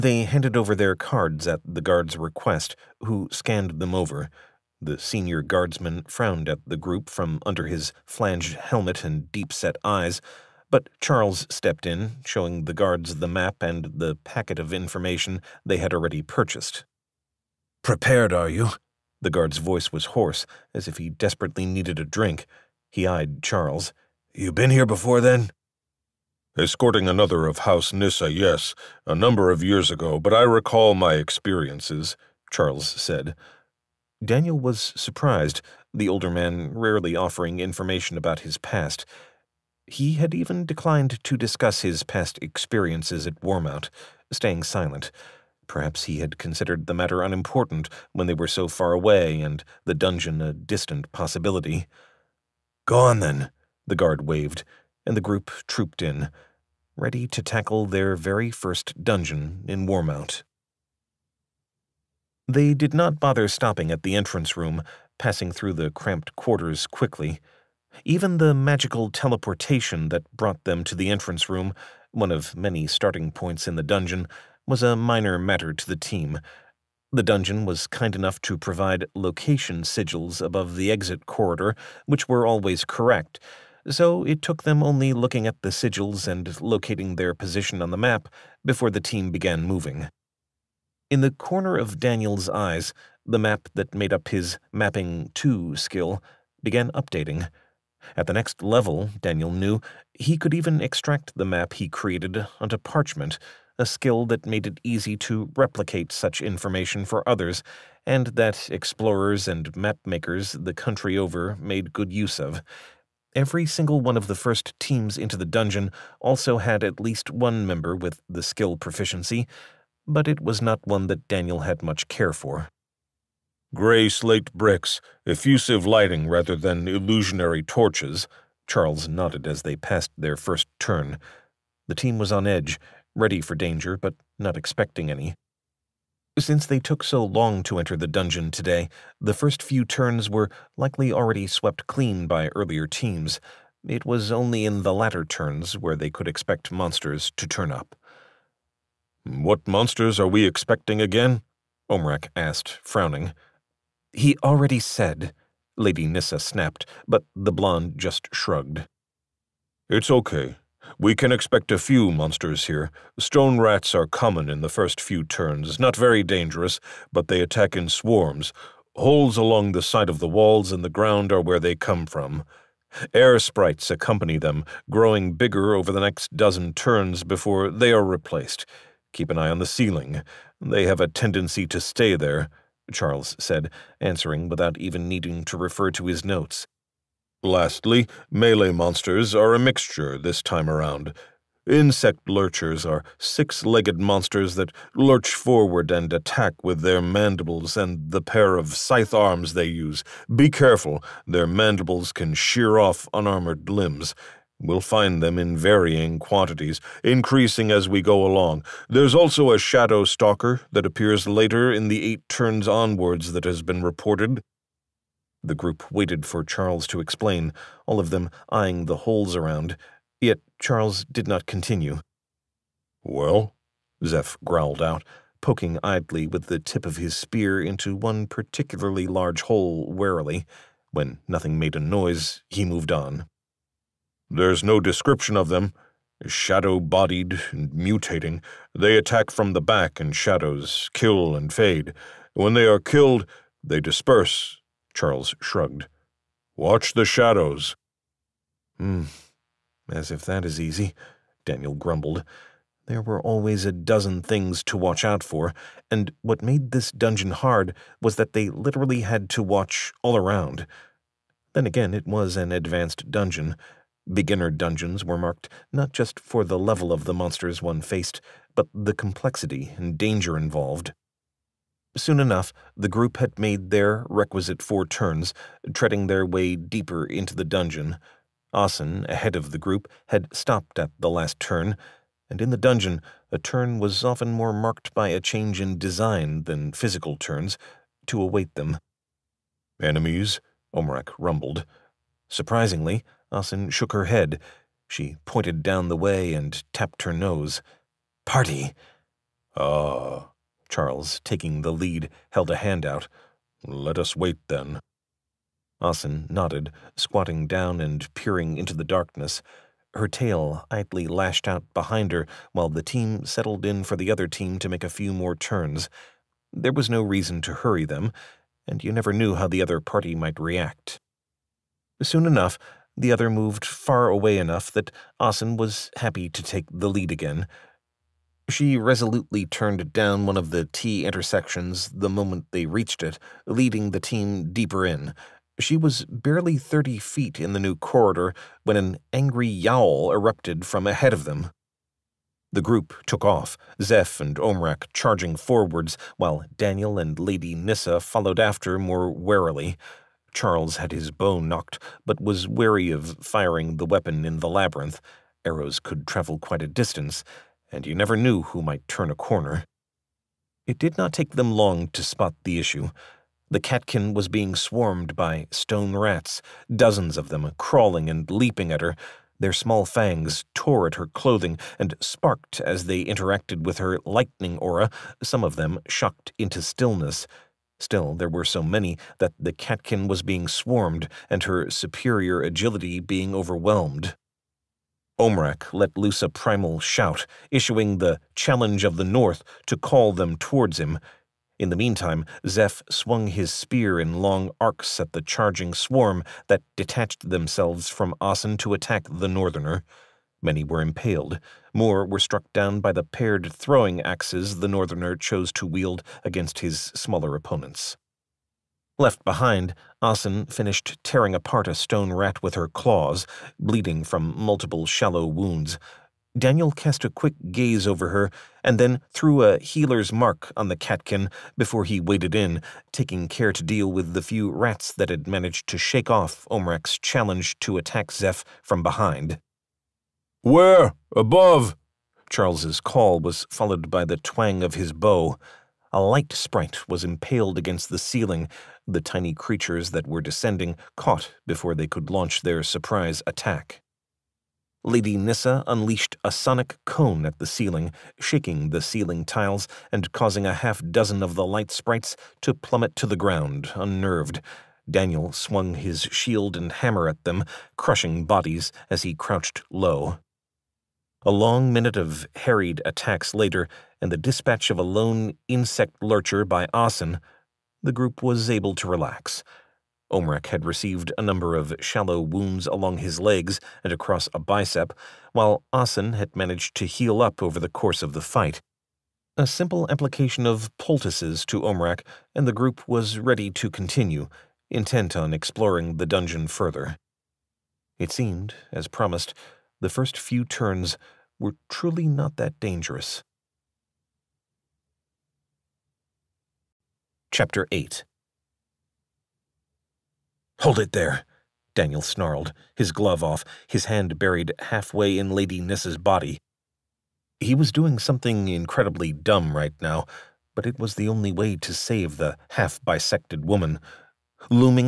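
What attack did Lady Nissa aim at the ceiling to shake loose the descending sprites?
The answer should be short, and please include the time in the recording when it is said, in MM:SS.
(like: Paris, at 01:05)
Sonic cone, at 07:26.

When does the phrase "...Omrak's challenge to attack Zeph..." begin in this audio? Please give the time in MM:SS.
07:06.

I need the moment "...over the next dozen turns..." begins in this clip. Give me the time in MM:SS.
02:55.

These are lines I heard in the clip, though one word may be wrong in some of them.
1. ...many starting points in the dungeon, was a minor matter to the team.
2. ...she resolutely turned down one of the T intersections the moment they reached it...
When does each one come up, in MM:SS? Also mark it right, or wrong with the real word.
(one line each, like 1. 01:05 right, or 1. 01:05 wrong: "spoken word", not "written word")
1. 01:12 right
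2. 05:28 right.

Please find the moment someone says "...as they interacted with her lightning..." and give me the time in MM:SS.
06:12.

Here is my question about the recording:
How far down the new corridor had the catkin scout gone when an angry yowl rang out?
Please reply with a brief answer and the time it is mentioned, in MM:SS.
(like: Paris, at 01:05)
30 feet, at 05:36.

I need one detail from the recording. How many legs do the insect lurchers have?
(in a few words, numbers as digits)
6.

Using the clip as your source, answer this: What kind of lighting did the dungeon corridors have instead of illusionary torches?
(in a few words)
Effusive lighting.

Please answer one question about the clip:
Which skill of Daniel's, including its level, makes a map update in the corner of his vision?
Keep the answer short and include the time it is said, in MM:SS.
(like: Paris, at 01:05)
Mapping 2, at 01:34.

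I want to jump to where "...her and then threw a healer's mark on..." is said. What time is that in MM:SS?
06:58.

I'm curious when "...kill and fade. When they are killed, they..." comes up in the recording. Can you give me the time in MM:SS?
04:00.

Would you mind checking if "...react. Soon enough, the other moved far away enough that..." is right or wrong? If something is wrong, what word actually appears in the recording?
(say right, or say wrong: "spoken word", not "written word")
right.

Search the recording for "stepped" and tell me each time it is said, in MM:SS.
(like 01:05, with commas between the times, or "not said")
00:11.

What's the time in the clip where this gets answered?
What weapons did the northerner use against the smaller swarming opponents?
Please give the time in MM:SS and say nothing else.
06:43.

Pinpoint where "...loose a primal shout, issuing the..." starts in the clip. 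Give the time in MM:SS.
06:25.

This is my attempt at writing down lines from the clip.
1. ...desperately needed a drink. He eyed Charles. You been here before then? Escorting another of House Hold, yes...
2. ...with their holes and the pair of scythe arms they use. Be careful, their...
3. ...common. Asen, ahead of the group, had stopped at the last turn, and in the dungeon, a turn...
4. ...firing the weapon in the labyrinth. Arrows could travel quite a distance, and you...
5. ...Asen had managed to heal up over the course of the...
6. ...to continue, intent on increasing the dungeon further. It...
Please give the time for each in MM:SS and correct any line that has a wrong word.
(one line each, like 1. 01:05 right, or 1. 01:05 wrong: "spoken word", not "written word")
1. 00:21 wrong: "Nissa", not "Hold"
2. 03:16 wrong: "mandibles", not "holes"
3. 04:37 wrong: "dungeon", not "common"
4. 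05:53 right
5. 07:55 right
6. 08:03 wrong: "exploring", not "increasing".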